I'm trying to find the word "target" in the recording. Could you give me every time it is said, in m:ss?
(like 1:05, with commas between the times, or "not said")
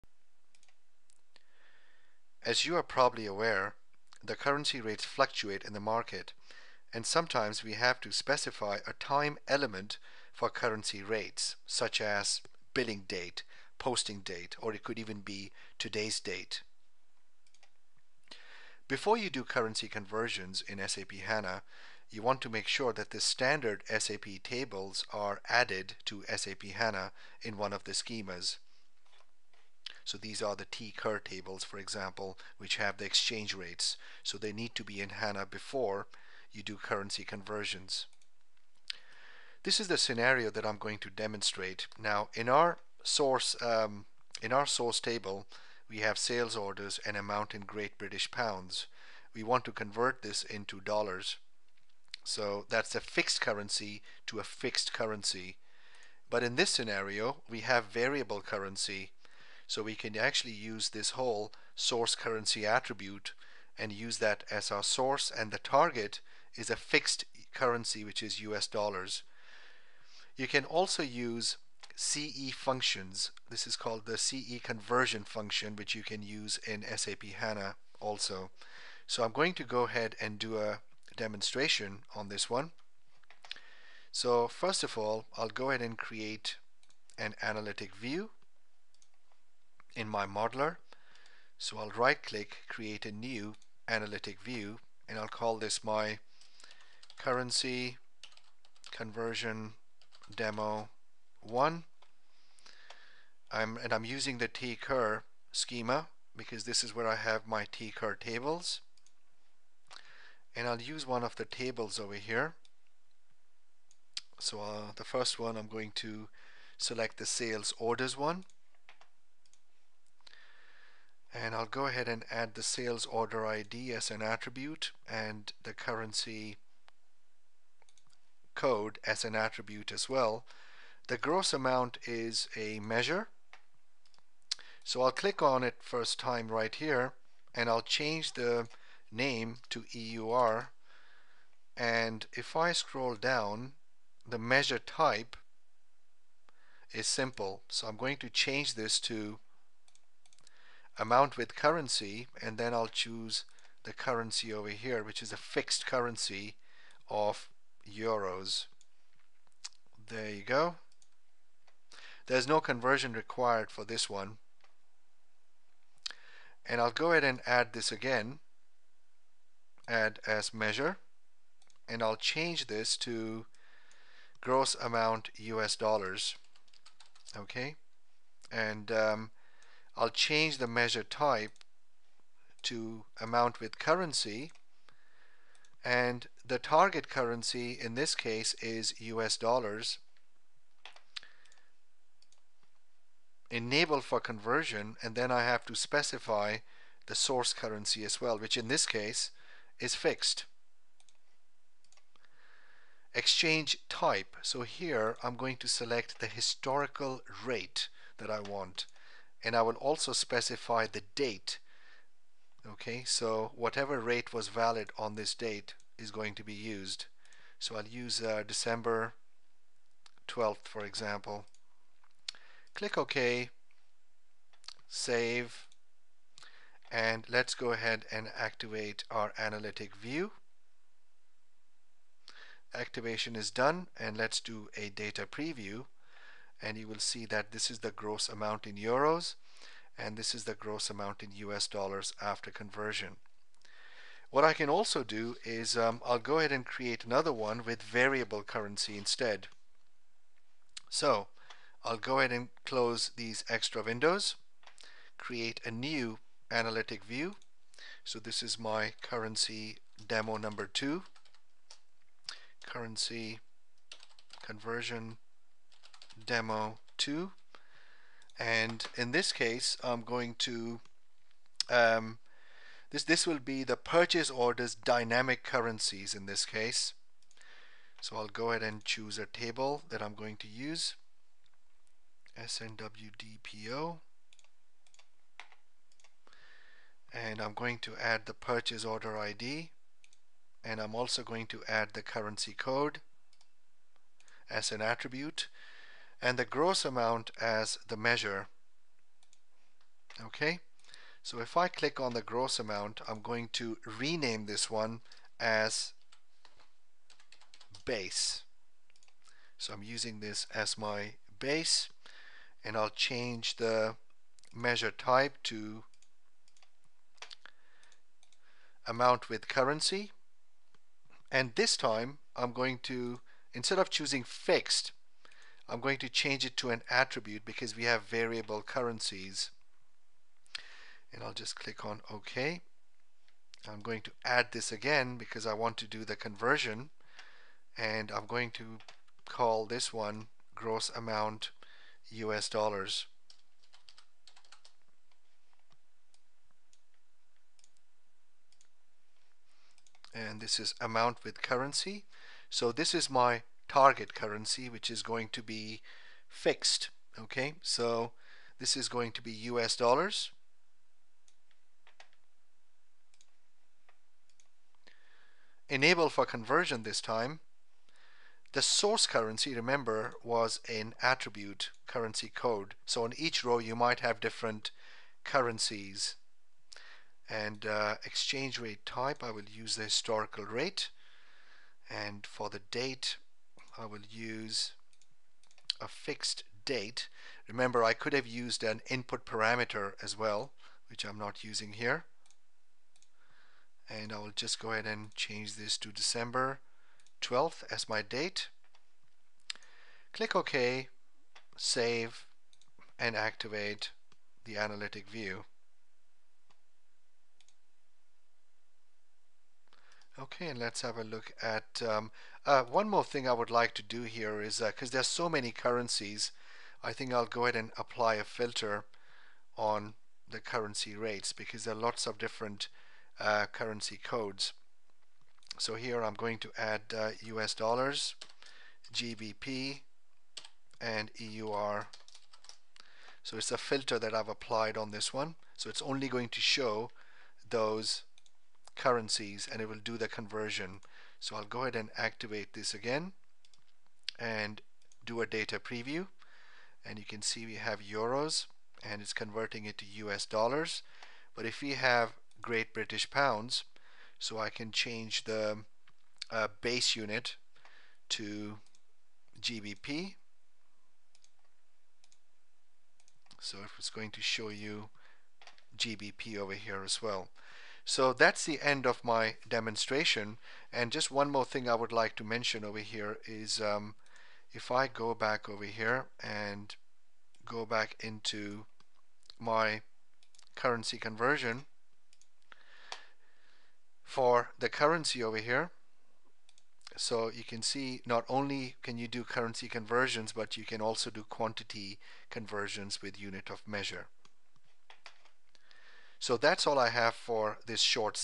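1:05, 3:06, 5:53.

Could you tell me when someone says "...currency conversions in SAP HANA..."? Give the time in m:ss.
0:19.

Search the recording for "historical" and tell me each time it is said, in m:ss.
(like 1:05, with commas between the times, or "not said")
3:26, 6:19.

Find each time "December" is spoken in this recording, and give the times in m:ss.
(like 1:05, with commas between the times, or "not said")
3:38, 6:35.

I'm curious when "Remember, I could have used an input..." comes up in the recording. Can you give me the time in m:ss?
6:27.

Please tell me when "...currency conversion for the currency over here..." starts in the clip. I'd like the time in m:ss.
8:00.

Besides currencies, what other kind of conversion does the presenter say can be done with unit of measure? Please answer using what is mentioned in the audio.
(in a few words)
quantity conversions.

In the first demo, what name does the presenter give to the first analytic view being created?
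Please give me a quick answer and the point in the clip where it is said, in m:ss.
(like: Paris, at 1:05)
currency conversion demo 1, at 1:37.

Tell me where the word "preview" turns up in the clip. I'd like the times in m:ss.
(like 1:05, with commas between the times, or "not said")
3:55, 7:25.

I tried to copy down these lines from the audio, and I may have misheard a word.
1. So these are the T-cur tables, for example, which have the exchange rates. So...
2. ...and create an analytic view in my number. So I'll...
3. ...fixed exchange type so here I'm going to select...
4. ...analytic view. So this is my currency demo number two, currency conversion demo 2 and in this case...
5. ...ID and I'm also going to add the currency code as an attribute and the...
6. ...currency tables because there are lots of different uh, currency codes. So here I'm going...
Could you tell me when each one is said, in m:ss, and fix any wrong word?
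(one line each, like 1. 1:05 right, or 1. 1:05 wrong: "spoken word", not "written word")
1. 0:30 right
2. 1:25 wrong: "modeler", not "number"
3. 3:19 right
4. 4:16 right
5. 4:49 right
6. 7:00 wrong: "rates", not "tables".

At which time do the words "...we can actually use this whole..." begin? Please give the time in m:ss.
0:59.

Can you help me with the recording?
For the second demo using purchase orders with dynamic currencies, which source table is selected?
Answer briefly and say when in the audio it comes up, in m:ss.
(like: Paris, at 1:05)
SNWDPO, at 4:42.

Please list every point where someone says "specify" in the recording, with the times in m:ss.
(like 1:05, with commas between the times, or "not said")
0:08, 3:15, 3:30.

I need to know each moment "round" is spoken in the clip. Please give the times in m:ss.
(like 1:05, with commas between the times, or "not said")
not said.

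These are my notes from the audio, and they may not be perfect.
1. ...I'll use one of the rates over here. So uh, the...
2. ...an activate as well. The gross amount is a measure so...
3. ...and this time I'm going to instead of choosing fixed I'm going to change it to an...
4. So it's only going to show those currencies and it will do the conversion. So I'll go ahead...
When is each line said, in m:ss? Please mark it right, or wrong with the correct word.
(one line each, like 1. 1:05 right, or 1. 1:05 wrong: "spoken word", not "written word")
1. 1:50 wrong: "tables", not "rates"
2. 2:09 wrong: "attribute", not "activate"
3. 5:21 right
4. 7:15 right.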